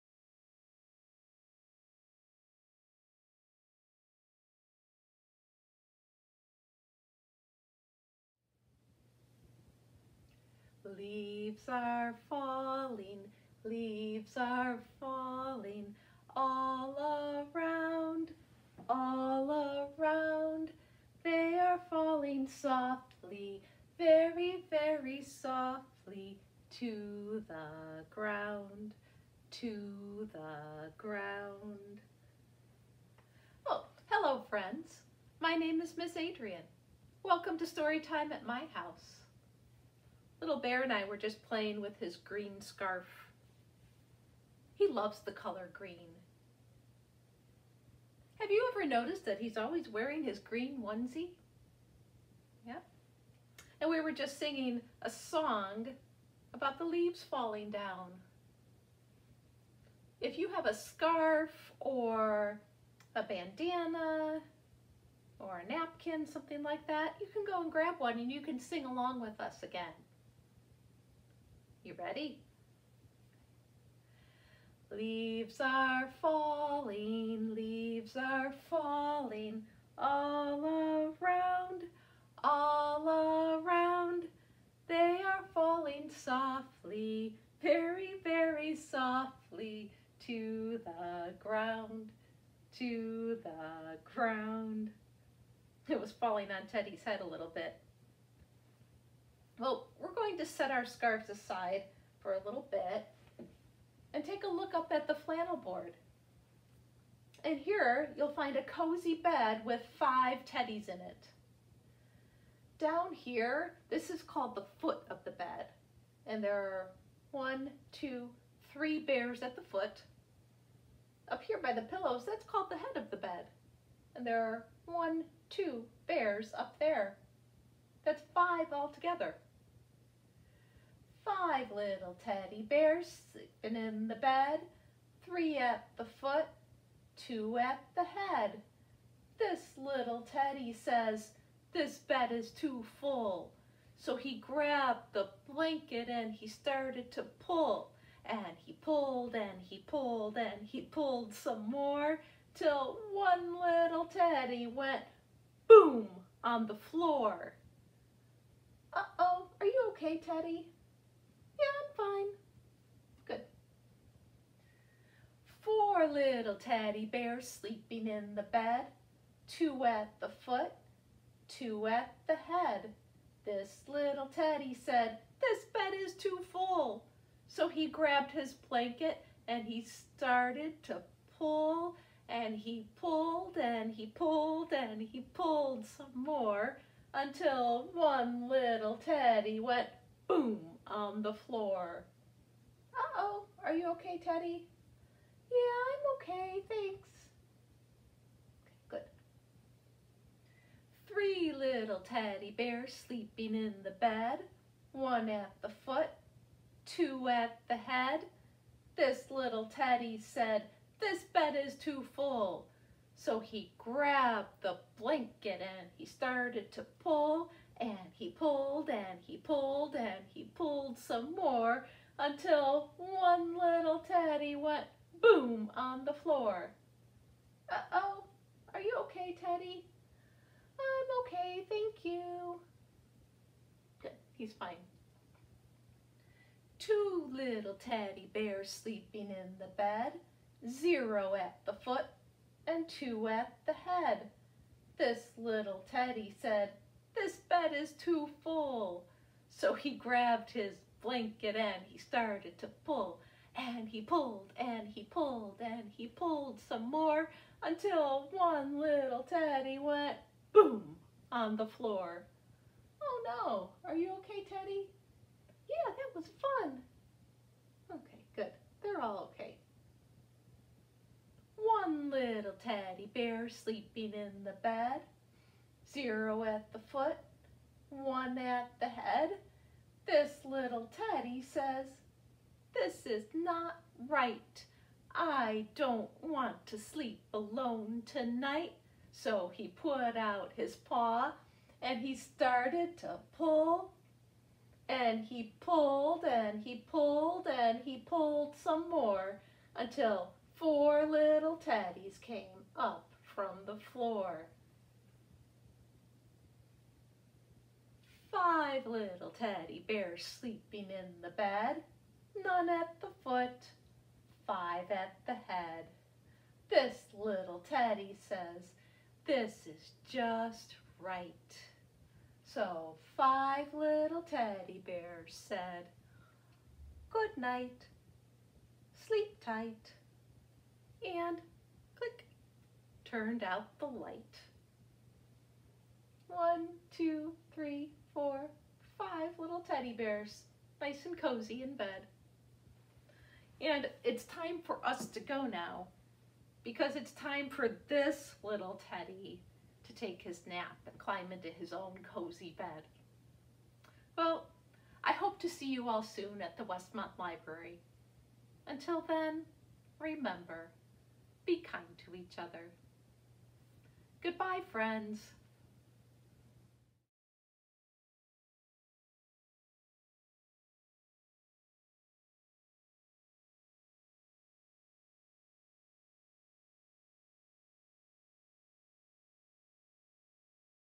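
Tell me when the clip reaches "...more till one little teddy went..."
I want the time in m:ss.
2:31.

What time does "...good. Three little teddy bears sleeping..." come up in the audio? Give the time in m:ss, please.
3:18.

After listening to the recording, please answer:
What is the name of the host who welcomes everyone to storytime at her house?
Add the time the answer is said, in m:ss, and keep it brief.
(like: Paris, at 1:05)
Miss Adrian, at 0:35.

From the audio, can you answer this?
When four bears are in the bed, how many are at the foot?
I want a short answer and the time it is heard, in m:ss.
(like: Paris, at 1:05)
2, at 2:49.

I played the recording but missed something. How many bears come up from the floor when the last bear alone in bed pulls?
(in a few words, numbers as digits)
4.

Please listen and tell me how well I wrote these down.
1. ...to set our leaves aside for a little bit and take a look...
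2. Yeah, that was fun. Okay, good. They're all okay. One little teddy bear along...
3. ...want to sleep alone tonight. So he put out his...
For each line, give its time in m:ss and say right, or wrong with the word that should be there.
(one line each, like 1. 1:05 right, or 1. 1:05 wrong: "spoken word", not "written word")
1. 1:40 wrong: "scarves", not "leaves"
2. 4:25 wrong: "sleeping", not "along"
3. 4:46 right.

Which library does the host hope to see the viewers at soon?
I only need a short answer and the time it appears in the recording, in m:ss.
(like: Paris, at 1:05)
Westmont Library, at 5:56.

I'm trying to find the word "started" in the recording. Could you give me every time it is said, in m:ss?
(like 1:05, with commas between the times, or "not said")
2:26, 2:59, 3:36, 4:11, 4:52.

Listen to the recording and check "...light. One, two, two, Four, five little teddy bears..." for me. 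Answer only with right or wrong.
wrong.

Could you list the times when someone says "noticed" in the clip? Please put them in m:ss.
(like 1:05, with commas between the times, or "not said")
0:48.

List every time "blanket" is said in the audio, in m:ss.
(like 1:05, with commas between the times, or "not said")
2:25, 2:58, 3:34, 4:11.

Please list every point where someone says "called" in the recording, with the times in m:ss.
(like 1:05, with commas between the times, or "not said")
1:54, 2:02.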